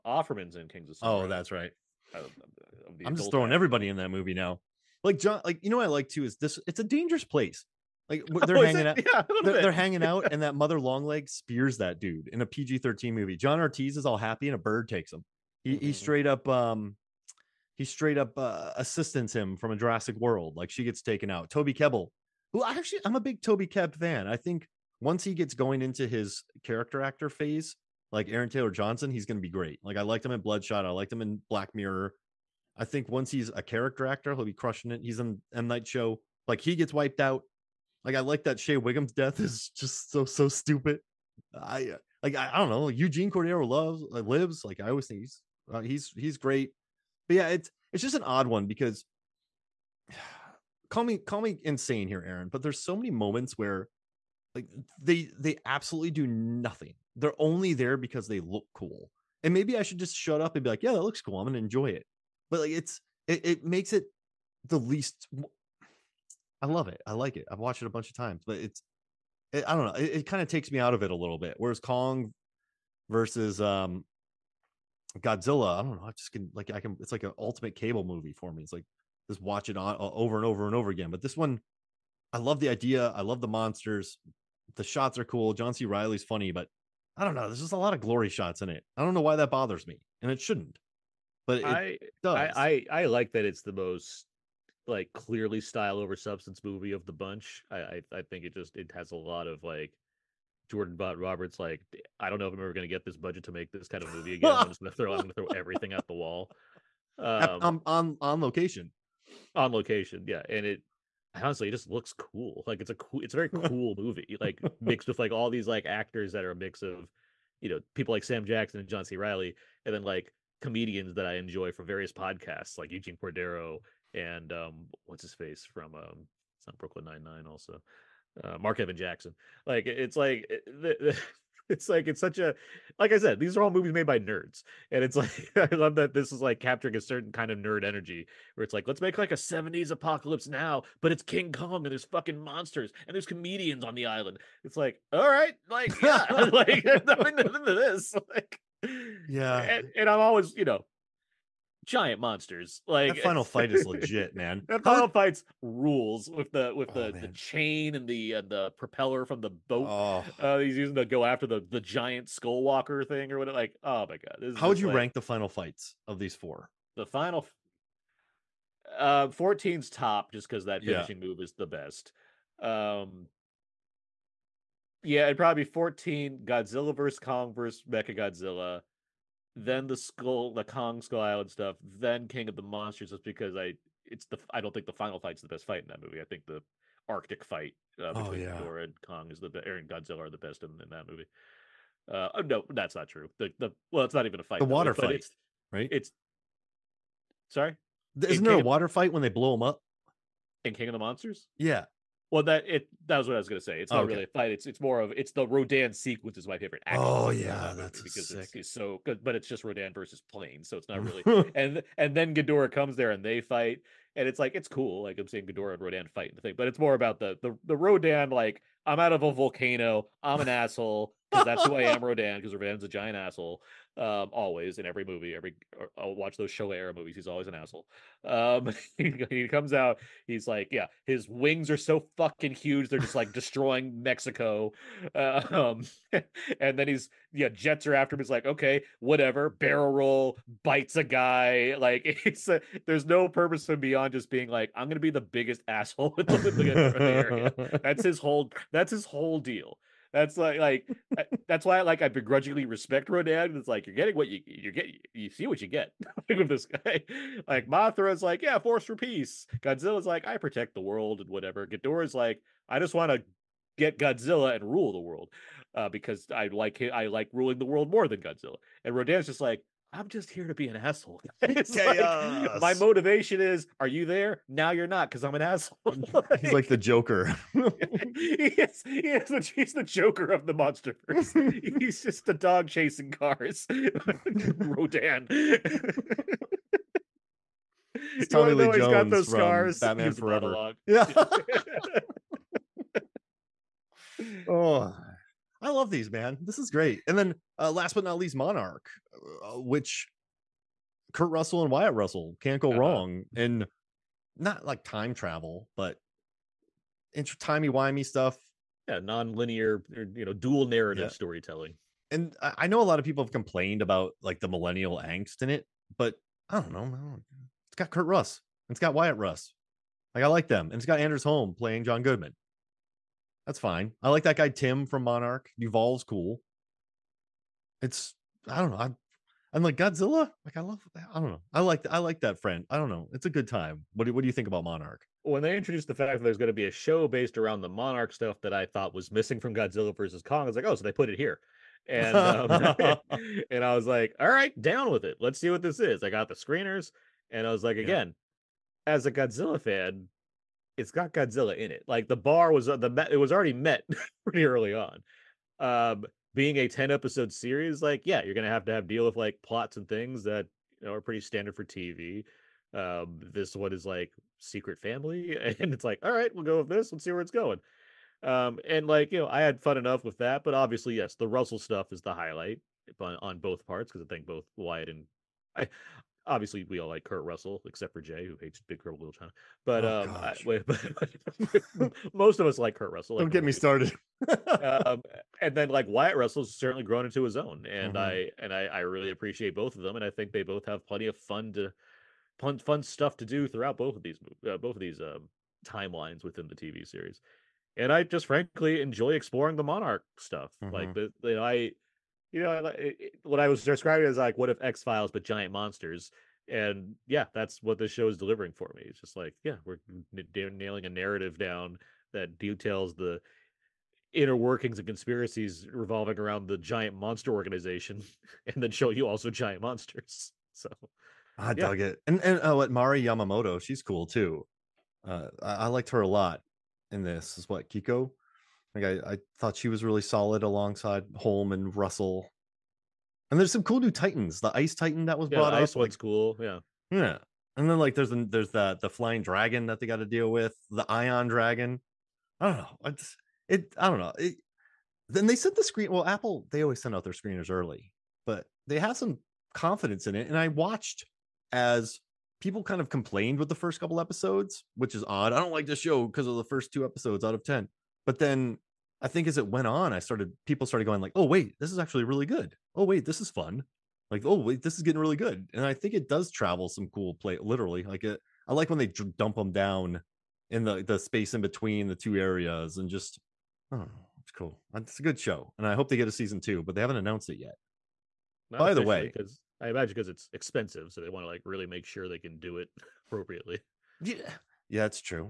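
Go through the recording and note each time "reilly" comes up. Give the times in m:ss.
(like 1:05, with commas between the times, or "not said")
1:25, 1:59.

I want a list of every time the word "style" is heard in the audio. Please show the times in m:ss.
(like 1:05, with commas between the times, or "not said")
1:35.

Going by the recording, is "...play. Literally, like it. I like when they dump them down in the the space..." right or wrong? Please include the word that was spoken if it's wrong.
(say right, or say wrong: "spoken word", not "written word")
right.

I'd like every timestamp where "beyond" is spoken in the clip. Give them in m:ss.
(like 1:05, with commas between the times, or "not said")
4:03.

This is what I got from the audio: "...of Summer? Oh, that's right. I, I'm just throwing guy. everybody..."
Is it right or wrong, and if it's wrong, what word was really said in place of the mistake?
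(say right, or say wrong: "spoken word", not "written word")
right.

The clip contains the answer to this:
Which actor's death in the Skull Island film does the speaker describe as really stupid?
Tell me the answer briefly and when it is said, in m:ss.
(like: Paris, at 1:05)
Shea Whigham, at 0:38.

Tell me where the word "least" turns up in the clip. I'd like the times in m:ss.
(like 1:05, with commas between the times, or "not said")
1:04, 4:58.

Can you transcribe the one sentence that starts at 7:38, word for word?
But then I think as it went on, I started people started going like, "Oh wait, this is actually really good.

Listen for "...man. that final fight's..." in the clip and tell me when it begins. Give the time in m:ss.
2:34.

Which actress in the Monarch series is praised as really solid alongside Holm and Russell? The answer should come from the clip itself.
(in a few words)
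Mari Yamamoto.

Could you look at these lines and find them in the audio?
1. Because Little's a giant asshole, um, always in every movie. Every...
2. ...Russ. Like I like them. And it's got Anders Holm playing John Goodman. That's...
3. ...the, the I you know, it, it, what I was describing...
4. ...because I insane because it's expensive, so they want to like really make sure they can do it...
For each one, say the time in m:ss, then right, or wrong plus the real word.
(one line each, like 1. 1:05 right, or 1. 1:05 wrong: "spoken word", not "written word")
1. 3:42 wrong: "Rodan", not "Little"
2. 5:19 right
3. 6:40 right
4. 7:59 wrong: "imagine", not "insane".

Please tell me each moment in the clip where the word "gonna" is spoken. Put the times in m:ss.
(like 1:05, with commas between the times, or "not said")
1:01, 3:23, 4:04, 5:58.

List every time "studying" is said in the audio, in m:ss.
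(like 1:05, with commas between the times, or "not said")
not said.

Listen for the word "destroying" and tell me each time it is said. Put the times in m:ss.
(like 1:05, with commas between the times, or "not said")
3:53.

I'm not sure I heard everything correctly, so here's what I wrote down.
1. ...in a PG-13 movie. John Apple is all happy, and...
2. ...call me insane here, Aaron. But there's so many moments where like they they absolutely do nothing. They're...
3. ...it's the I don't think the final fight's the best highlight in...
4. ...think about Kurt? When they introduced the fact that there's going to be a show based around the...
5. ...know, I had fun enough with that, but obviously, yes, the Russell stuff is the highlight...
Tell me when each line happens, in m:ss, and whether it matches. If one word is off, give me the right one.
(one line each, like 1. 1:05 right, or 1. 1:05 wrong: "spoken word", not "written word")
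1. 0:12 wrong: "Ortiz", not "Apple"
2. 0:51 right
3. 3:04 wrong: "fight", not "highlight"
4. 5:34 wrong: "Monarch", not "Kurt"
5. 6:09 right.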